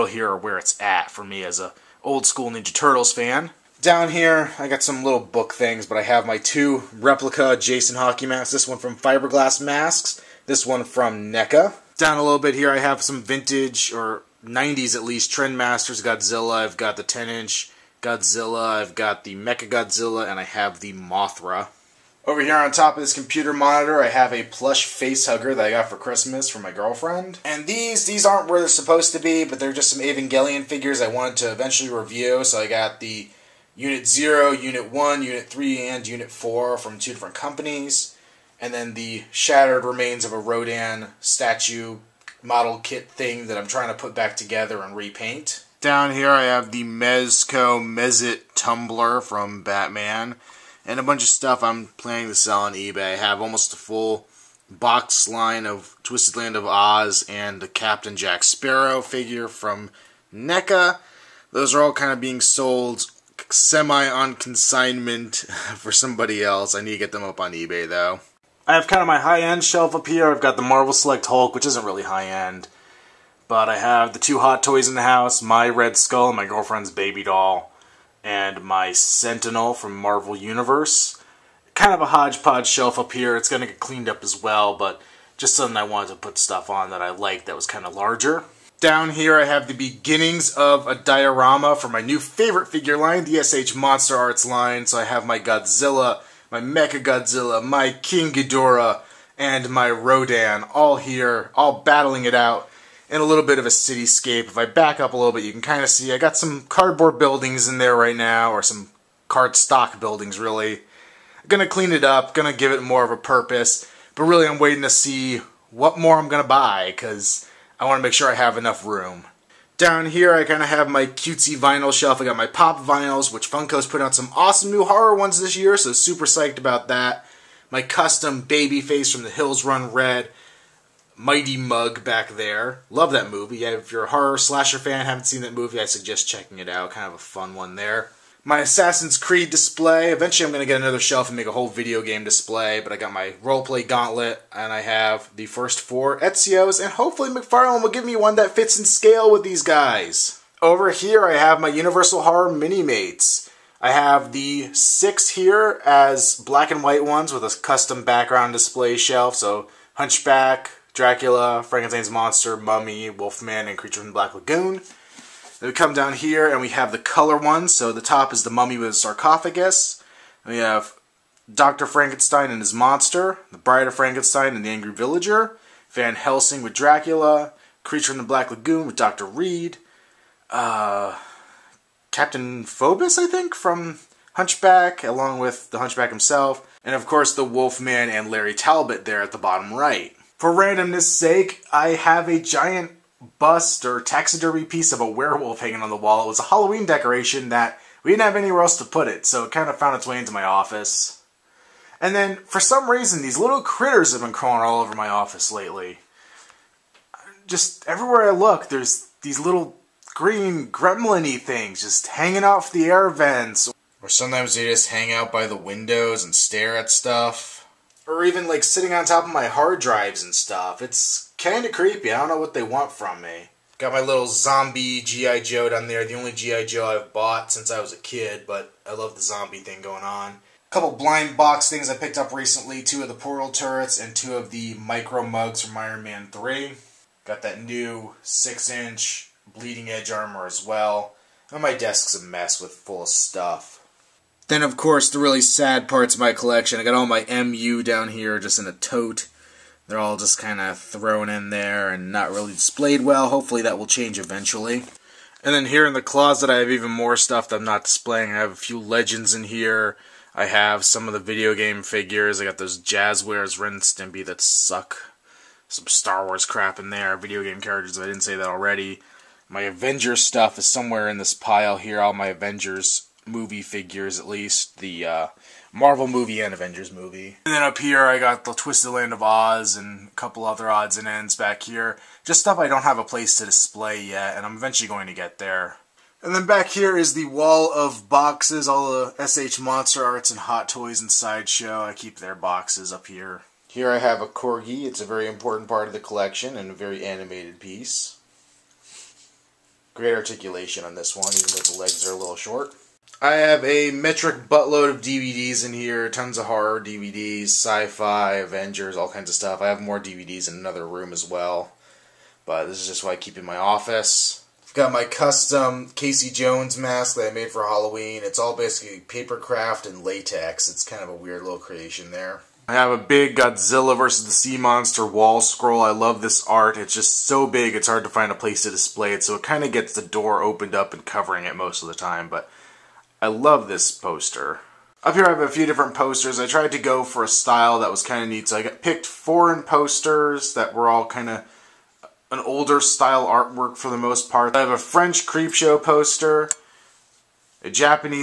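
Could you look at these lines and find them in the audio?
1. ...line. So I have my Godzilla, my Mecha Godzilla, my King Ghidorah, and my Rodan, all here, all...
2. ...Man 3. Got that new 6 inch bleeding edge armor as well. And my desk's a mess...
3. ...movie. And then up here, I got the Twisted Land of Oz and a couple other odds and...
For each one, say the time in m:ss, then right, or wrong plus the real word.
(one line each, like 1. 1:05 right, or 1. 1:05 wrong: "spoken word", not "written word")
1. 1:34 right
2. 3:56 right
3. 4:36 right.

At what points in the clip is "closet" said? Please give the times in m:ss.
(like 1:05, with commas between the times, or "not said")
4:16.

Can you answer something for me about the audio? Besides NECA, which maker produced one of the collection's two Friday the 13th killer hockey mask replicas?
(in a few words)
Fiberglass Masks.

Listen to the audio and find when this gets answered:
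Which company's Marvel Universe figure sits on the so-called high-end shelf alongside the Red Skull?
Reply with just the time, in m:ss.
1:18.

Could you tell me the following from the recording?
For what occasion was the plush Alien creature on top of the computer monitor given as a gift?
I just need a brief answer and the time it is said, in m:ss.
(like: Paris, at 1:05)
Christmas, at 0:25.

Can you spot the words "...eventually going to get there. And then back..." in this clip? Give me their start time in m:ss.
4:44.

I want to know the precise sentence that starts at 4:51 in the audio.
I keep their boxes up here.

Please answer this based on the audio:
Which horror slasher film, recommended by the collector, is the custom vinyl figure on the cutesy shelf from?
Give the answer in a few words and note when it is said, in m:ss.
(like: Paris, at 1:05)
The Hills Run Red, at 2:09.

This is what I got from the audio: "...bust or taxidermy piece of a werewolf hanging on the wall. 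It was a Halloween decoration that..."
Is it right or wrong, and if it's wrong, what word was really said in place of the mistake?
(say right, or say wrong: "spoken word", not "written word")
right.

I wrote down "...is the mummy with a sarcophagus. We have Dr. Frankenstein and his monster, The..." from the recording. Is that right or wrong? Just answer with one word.
right.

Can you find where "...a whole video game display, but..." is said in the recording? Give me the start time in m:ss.
2:21.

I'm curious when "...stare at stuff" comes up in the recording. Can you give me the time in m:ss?
3:36.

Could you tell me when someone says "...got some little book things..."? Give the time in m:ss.
0:04.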